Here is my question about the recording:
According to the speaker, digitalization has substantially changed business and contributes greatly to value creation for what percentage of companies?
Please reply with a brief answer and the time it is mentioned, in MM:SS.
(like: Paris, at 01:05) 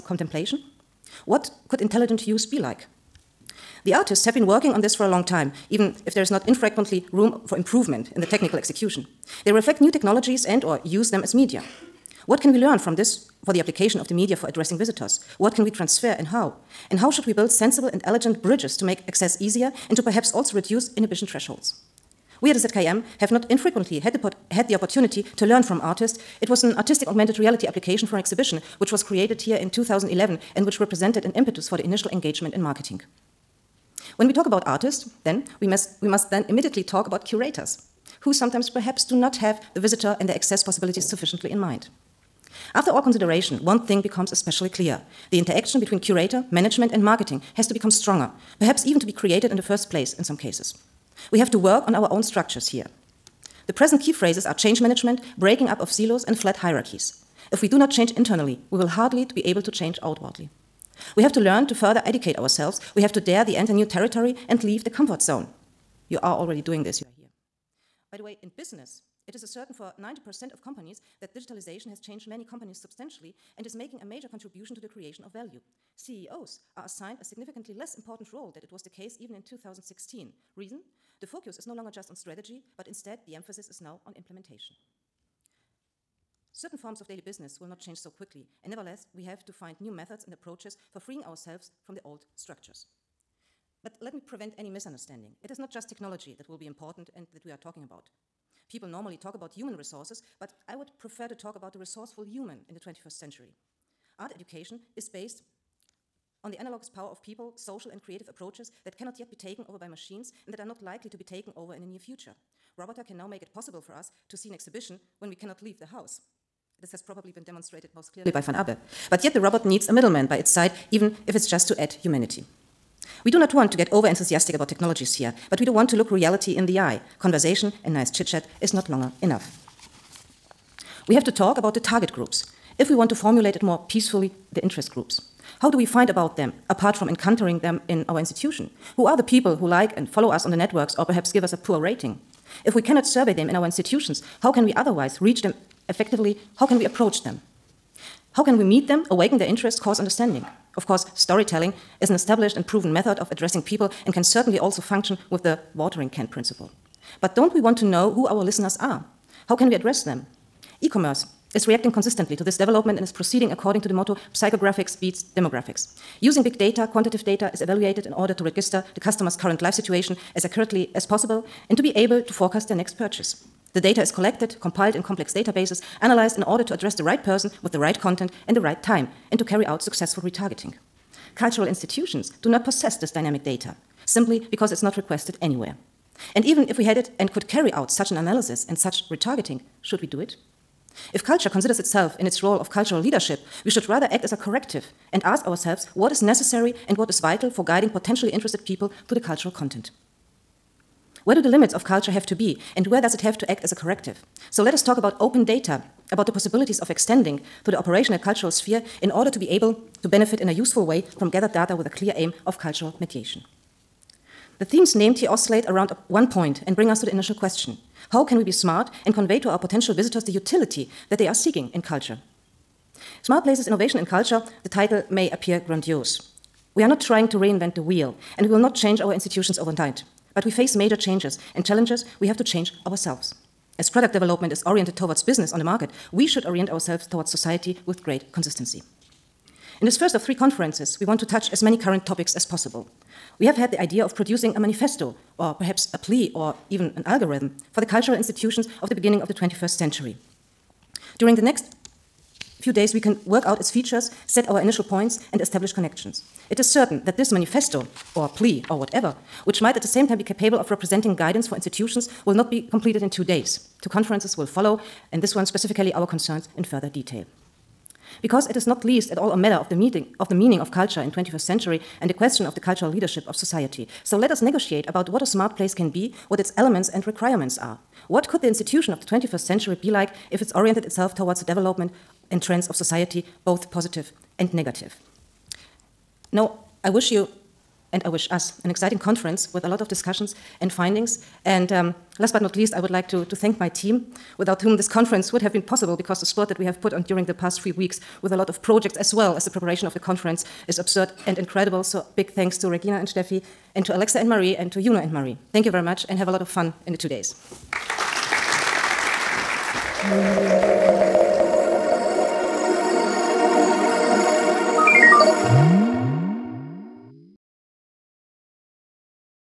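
90%, at 01:09.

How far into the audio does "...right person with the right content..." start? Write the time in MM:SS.
02:57.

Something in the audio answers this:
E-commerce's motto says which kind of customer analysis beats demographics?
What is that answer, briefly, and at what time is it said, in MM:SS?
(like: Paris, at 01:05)
Psychographics, at 02:44.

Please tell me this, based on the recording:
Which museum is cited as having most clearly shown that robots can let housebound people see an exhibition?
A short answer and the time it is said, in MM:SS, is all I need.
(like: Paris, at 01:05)
Van Abbe, at 01:58.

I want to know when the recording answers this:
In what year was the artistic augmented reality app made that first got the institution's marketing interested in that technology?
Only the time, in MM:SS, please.
00:29.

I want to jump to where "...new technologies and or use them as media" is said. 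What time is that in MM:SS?
00:09.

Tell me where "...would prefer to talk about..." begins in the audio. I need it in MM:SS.
01:40.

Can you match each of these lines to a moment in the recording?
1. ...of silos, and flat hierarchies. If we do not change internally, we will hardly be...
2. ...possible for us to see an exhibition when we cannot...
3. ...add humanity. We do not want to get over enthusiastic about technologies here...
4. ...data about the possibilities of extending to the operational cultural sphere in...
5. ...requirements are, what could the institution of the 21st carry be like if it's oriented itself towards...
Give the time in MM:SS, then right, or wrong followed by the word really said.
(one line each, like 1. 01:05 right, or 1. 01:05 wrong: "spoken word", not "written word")
1. 00:55 right
2. 01:53 right
3. 02:01 right
4. 03:25 right
5. 04:37 wrong: "century", not "carry".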